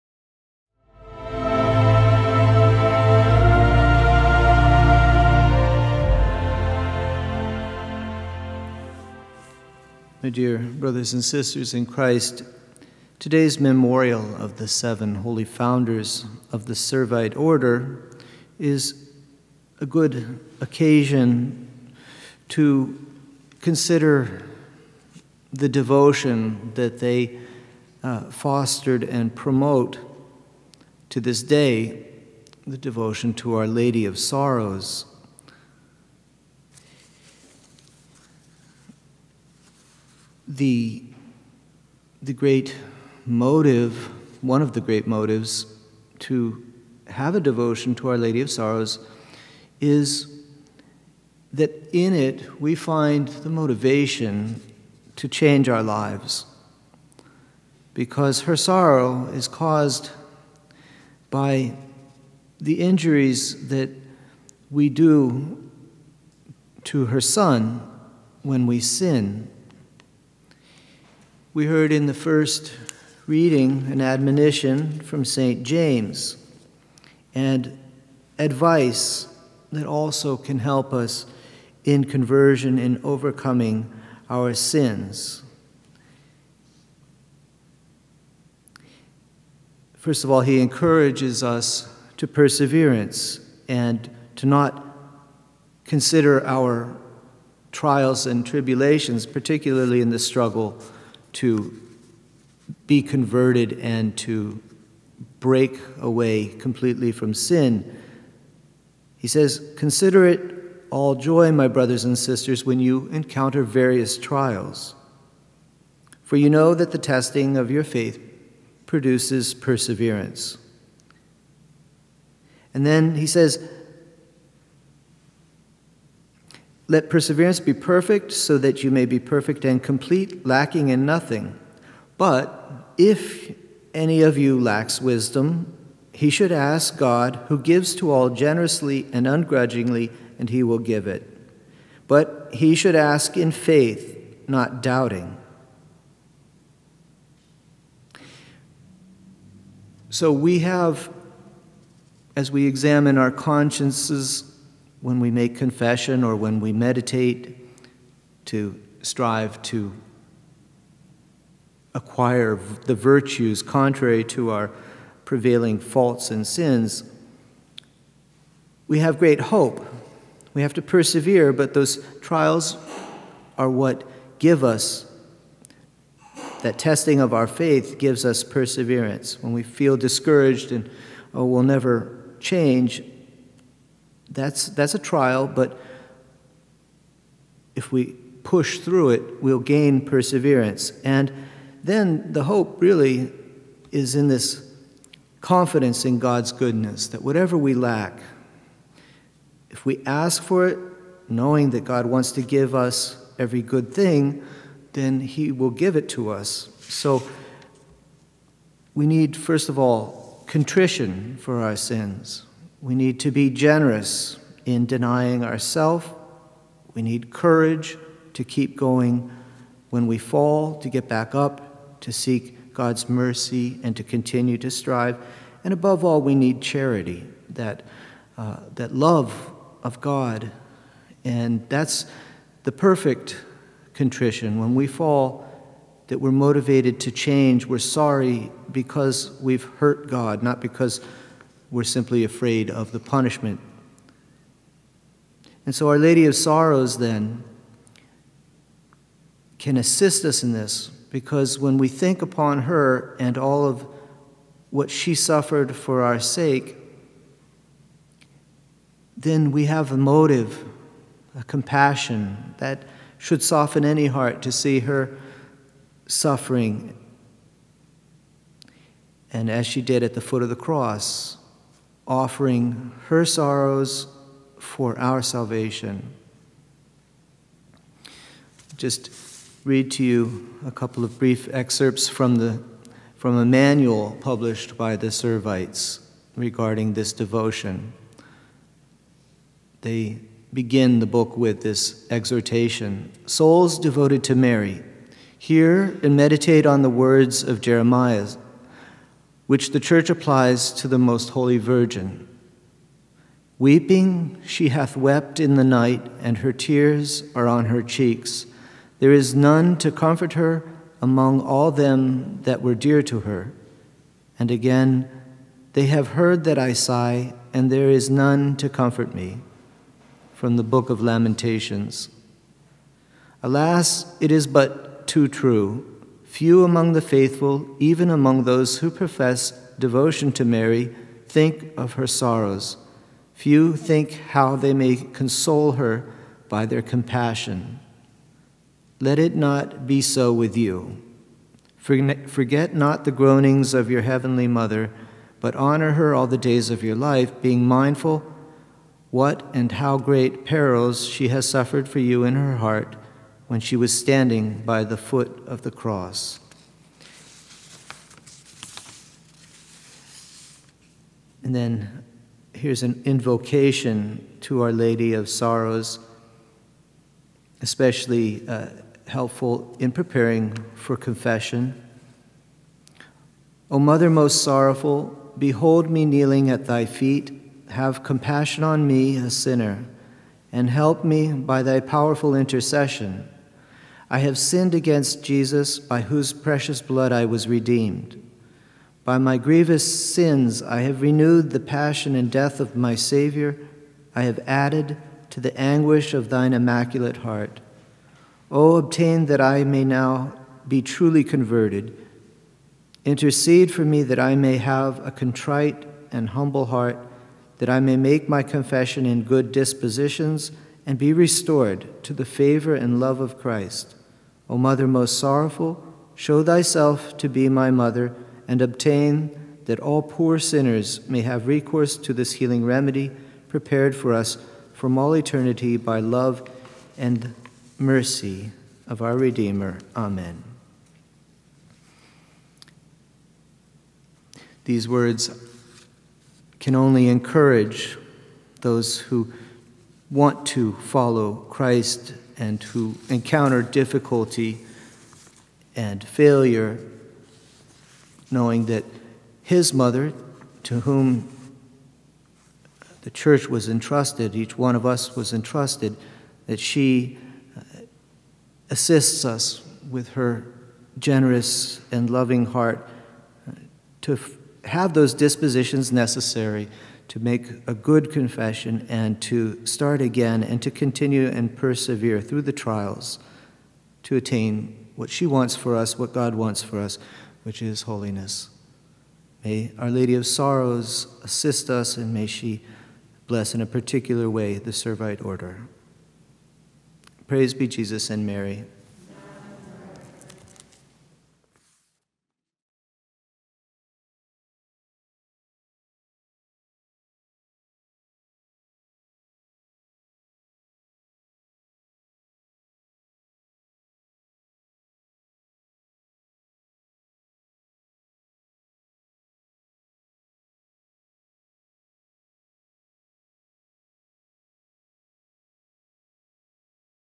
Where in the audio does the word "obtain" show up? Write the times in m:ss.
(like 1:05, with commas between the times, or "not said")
6:38, 6:58.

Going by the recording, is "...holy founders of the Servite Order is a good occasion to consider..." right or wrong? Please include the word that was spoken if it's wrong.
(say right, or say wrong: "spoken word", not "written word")
right.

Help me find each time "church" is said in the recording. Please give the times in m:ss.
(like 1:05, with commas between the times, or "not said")
4:59, 7:33.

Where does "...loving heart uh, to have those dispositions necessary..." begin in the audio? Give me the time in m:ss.
7:42.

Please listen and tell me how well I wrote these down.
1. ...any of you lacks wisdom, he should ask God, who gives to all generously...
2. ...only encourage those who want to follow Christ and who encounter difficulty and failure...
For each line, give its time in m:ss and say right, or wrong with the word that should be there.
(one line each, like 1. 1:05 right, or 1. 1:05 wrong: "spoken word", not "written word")
1. 2:13 right
2. 7:16 right.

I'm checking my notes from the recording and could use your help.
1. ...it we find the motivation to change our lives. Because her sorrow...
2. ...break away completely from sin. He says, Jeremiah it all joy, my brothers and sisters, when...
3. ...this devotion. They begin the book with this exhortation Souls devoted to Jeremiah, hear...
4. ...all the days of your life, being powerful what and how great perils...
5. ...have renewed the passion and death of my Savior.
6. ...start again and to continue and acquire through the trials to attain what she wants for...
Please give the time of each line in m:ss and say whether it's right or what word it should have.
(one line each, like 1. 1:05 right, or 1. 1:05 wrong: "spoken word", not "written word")
1. 0:52 right
2. 1:45 wrong: "Consider", not "Jeremiah"
3. 4:46 wrong: "Mary", not "Jeremiah"
4. 5:46 wrong: "mindful", not "powerful"
5. 6:30 right
6. 7:49 wrong: "persevere", not "acquire".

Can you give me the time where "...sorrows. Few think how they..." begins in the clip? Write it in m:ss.
5:32.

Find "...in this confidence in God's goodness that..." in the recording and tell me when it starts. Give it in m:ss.
3:14.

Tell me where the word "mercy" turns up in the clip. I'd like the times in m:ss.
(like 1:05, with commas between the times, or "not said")
3:43, 7:07.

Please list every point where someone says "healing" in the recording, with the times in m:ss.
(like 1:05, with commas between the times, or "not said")
7:02.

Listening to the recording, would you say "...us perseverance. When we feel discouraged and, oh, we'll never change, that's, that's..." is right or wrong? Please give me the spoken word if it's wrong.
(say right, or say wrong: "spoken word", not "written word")
right.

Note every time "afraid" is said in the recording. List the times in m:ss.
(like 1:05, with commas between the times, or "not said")
4:02.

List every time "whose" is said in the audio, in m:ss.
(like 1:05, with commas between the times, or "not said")
6:26.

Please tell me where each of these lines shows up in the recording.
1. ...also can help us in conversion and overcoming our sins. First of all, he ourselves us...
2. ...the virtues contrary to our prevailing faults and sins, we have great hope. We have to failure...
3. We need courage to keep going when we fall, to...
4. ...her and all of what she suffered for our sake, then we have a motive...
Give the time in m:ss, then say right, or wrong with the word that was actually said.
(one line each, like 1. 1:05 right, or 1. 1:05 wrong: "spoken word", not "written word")
1. 1:19 wrong: "encourages", not "ourselves"
2. 2:42 wrong: "persevere", not "failure"
3. 3:36 right
4. 4:12 right.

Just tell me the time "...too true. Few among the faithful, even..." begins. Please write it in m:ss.
5:25.